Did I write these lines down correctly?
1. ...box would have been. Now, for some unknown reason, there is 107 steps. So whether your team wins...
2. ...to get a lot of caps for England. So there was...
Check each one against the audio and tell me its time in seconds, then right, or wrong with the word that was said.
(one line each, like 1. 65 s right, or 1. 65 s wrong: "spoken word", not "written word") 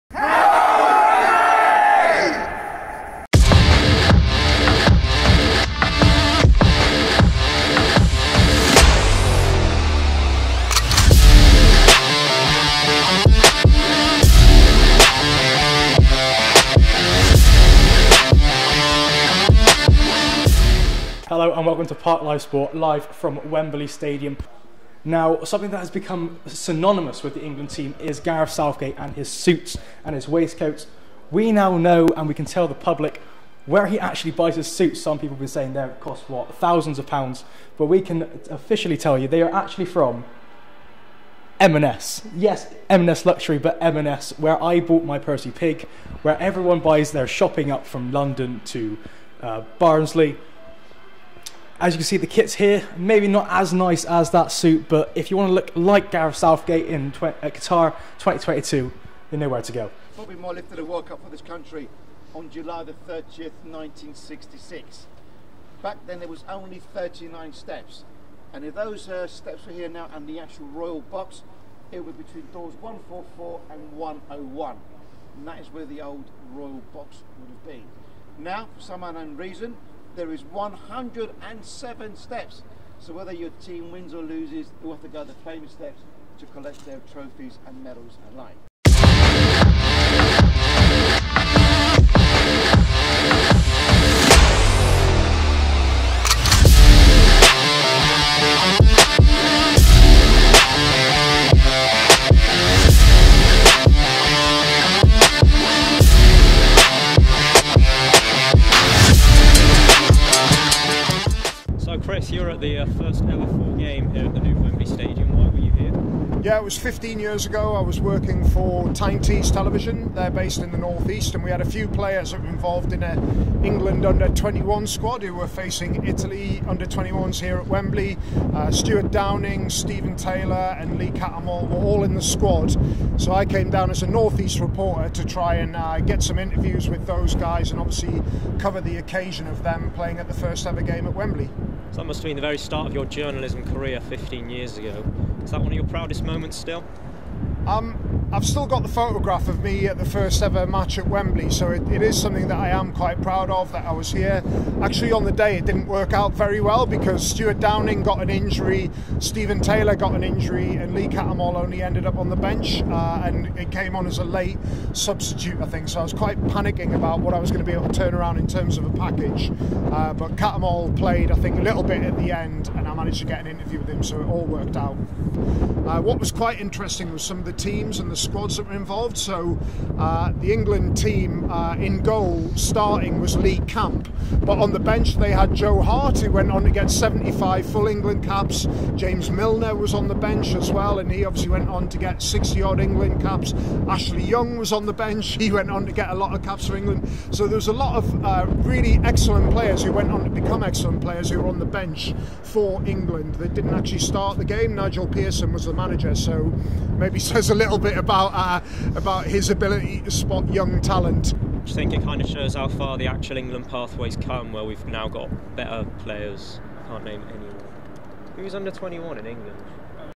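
1. 76 s right
2. 195 s right.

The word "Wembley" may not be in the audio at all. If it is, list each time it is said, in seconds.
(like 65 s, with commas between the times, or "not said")
23 s, 114 s, 127 s, 141 s, 151 s.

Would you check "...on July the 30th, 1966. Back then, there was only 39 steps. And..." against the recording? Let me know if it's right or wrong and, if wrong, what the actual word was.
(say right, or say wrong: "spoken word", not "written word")
right.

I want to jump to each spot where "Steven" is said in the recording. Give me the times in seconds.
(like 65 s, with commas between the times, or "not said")
129 s, 159 s.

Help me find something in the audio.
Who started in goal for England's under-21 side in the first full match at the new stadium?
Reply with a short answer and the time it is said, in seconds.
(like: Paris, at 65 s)
Lee Camp, at 183 s.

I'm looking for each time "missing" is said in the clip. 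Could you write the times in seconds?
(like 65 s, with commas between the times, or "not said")
not said.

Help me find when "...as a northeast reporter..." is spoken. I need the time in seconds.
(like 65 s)
133 s.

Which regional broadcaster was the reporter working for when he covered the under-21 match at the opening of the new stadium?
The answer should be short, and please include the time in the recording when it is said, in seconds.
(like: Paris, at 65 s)
Tyne Tees Television, at 118 s.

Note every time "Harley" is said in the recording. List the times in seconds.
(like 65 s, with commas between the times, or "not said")
not said.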